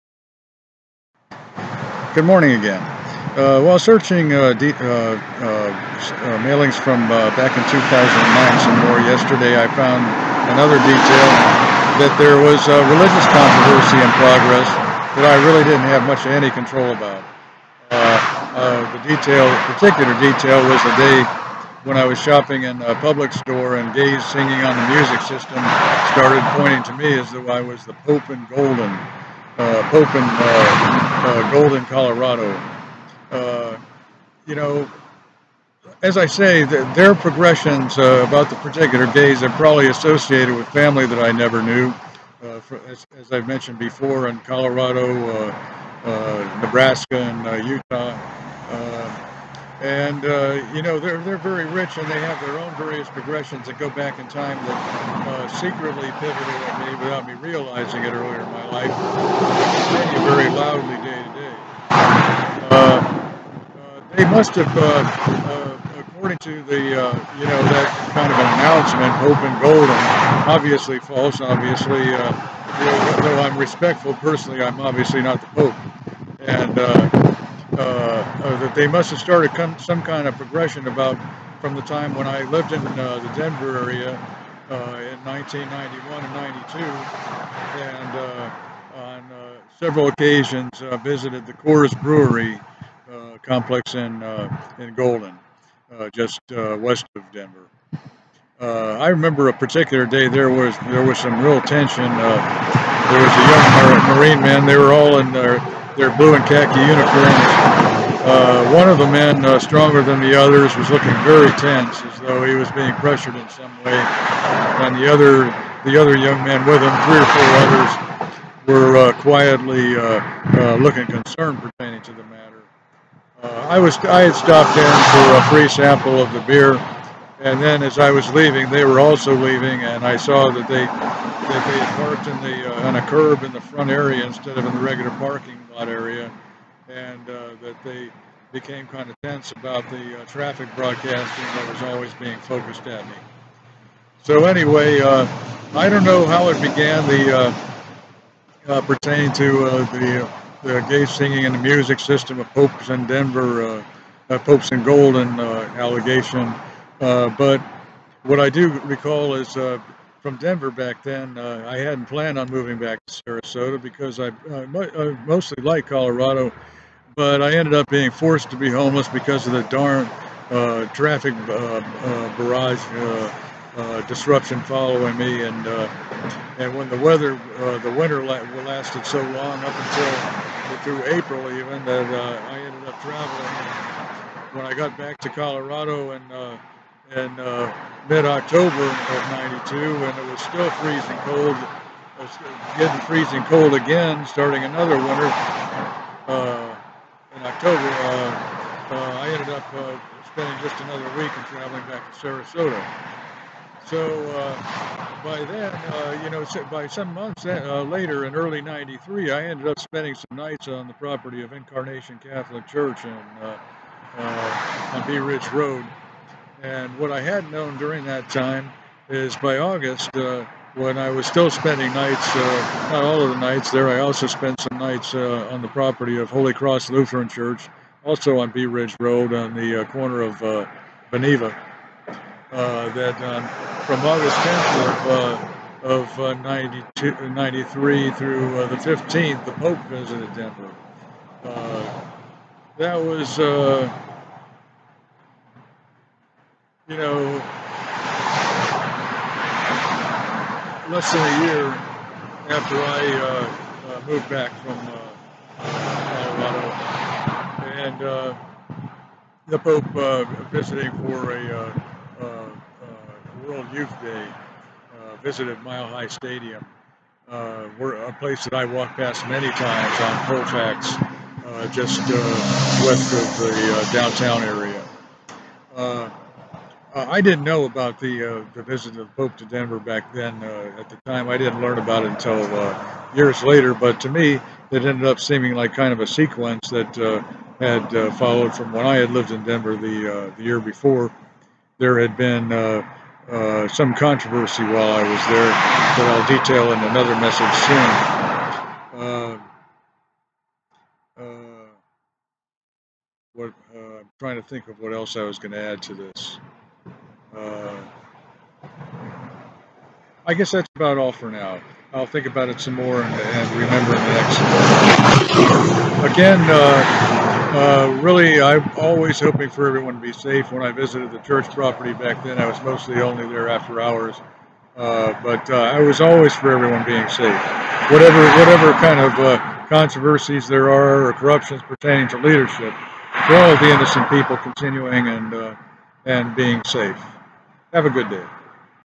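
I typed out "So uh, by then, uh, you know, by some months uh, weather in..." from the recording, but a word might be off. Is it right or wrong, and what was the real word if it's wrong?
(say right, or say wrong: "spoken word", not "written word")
wrong: "later", not "weather".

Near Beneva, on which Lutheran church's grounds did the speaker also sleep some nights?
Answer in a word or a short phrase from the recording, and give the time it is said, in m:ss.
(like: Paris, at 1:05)
Holy Cross Lutheran Church, at 3:46.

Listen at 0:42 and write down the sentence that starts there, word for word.
For, as, as, I've mentioned before, in Colorado, Nebraska, and Utah.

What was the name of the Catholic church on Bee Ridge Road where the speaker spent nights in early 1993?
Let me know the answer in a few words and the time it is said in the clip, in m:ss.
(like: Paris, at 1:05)
Incarnation Catholic Church, at 3:31.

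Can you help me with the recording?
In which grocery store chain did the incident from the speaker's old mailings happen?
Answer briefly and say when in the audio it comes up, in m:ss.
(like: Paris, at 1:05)
Publix, at 0:22.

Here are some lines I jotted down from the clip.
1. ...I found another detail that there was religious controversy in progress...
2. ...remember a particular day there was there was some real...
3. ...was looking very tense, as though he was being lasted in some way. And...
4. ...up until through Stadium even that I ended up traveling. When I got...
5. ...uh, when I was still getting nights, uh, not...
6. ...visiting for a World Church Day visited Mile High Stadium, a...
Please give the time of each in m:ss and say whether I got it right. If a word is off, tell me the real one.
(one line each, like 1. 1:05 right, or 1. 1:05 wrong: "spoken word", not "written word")
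1. 0:09 right
2. 1:39 right
3. 1:50 wrong: "pressured", not "lasted"
4. 2:59 wrong: "April", not "Stadium"
5. 3:40 wrong: "spending", not "getting"
6. 4:20 wrong: "Youth", not "Church".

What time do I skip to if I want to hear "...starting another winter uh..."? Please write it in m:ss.
3:14.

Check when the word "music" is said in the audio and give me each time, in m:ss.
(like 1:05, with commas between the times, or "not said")
0:24, 2:31.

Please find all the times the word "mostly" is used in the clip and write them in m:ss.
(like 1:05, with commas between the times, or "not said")
2:45, 5:22.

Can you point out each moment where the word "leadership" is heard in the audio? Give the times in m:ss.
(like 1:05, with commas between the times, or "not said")
5:32.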